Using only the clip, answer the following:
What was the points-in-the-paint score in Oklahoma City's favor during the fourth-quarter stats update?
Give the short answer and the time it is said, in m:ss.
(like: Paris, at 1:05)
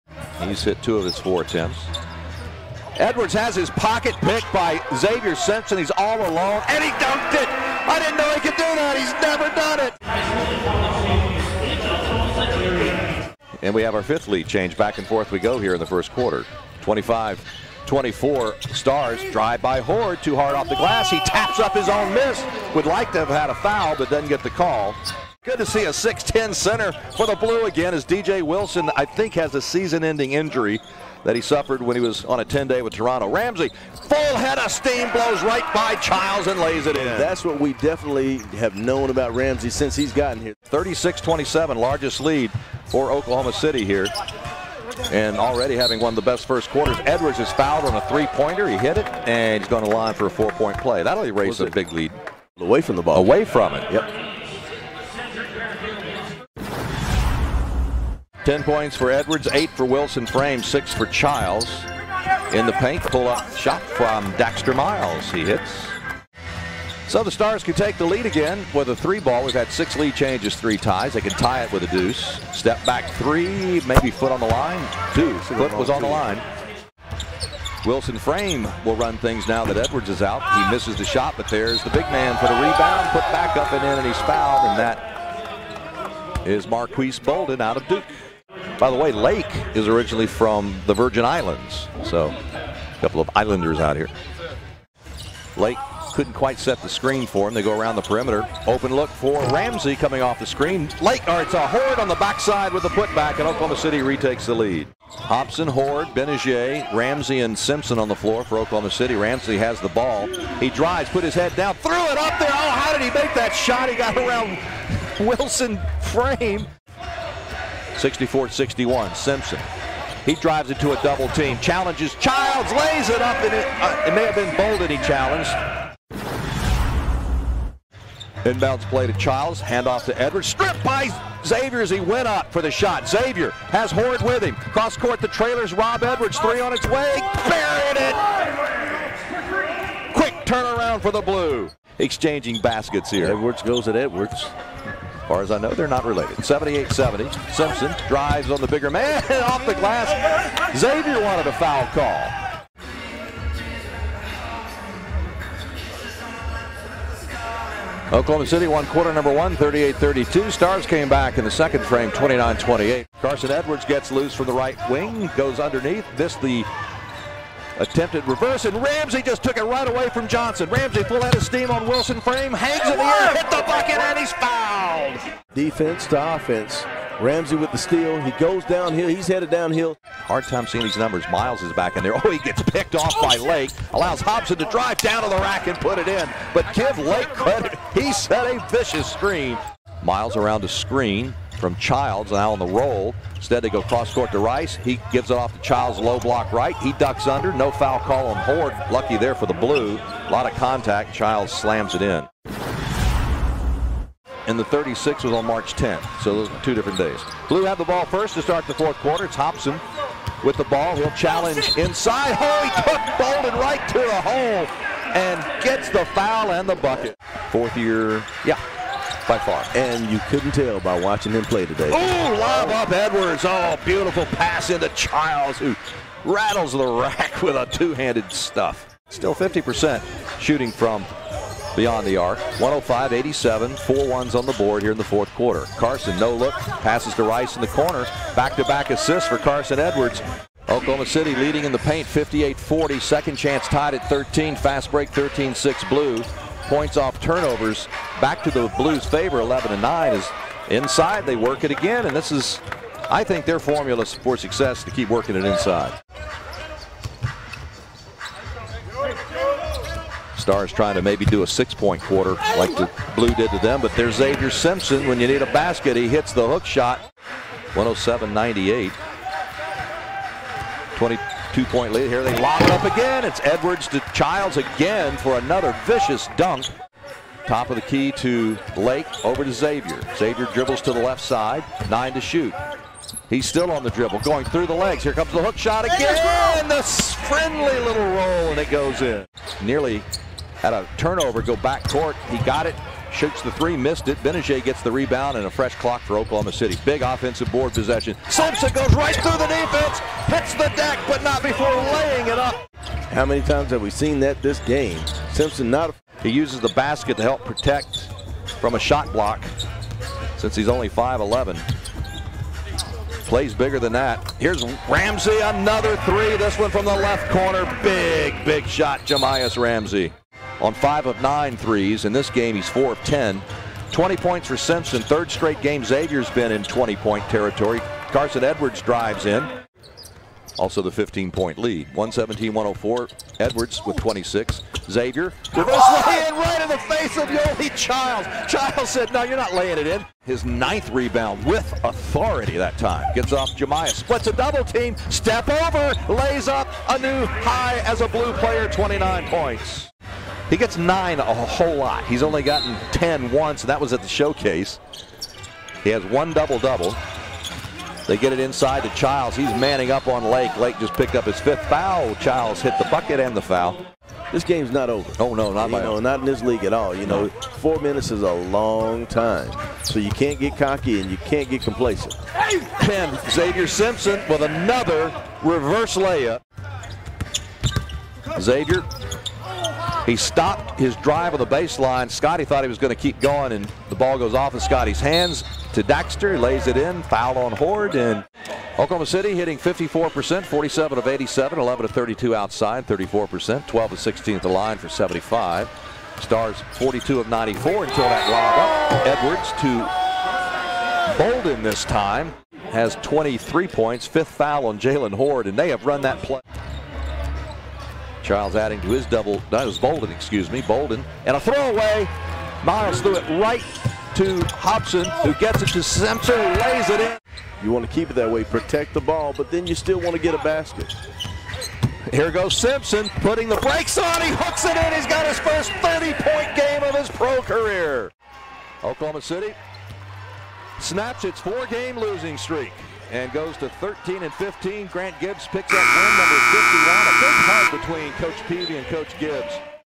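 58-40, at 4:02.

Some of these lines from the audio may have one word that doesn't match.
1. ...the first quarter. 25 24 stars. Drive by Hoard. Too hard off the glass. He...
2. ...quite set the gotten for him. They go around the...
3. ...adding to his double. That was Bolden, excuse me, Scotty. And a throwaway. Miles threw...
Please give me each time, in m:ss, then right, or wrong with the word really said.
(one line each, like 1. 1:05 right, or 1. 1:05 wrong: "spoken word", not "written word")
1. 0:15 right
2. 1:36 wrong: "screen", not "gotten"
3. 6:48 wrong: "Bolden", not "Scotty".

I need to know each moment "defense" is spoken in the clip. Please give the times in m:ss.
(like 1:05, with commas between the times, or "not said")
2:55, 4:59.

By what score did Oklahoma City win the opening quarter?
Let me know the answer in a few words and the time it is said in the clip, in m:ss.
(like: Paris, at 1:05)
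38-32, at 2:39.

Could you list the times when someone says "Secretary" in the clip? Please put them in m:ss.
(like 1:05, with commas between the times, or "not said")
not said.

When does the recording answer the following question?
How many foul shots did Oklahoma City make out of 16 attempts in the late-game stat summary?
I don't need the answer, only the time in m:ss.
6:33.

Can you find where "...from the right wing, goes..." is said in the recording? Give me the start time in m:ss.
2:44.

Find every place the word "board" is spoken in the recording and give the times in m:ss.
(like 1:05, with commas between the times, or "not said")
3:54, 4:57.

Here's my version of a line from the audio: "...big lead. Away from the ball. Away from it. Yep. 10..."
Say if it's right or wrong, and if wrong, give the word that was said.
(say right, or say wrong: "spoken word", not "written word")
right.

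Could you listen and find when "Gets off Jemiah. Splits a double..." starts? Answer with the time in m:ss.
5:43.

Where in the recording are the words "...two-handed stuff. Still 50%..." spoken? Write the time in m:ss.
3:47.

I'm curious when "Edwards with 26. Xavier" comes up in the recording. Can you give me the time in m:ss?
5:33.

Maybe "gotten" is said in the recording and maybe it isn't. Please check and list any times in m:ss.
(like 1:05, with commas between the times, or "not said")
0:40, 5:52.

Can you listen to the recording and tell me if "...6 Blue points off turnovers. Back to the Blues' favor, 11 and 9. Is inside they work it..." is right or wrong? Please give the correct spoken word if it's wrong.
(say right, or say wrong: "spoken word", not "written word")
right.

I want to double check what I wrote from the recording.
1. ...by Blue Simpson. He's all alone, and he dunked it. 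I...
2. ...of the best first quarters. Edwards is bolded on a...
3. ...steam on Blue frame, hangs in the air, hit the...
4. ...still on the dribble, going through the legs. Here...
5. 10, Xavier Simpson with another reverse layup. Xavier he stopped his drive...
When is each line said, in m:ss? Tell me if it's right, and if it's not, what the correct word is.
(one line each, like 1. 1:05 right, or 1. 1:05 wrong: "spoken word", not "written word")
1. 0:04 wrong: "Xavier", not "Blue"
2. 0:46 wrong: "fouled", not "bolded"
3. 2:51 wrong: "Wilson", not "Blue"
4. 4:43 right
5. 6:12 right.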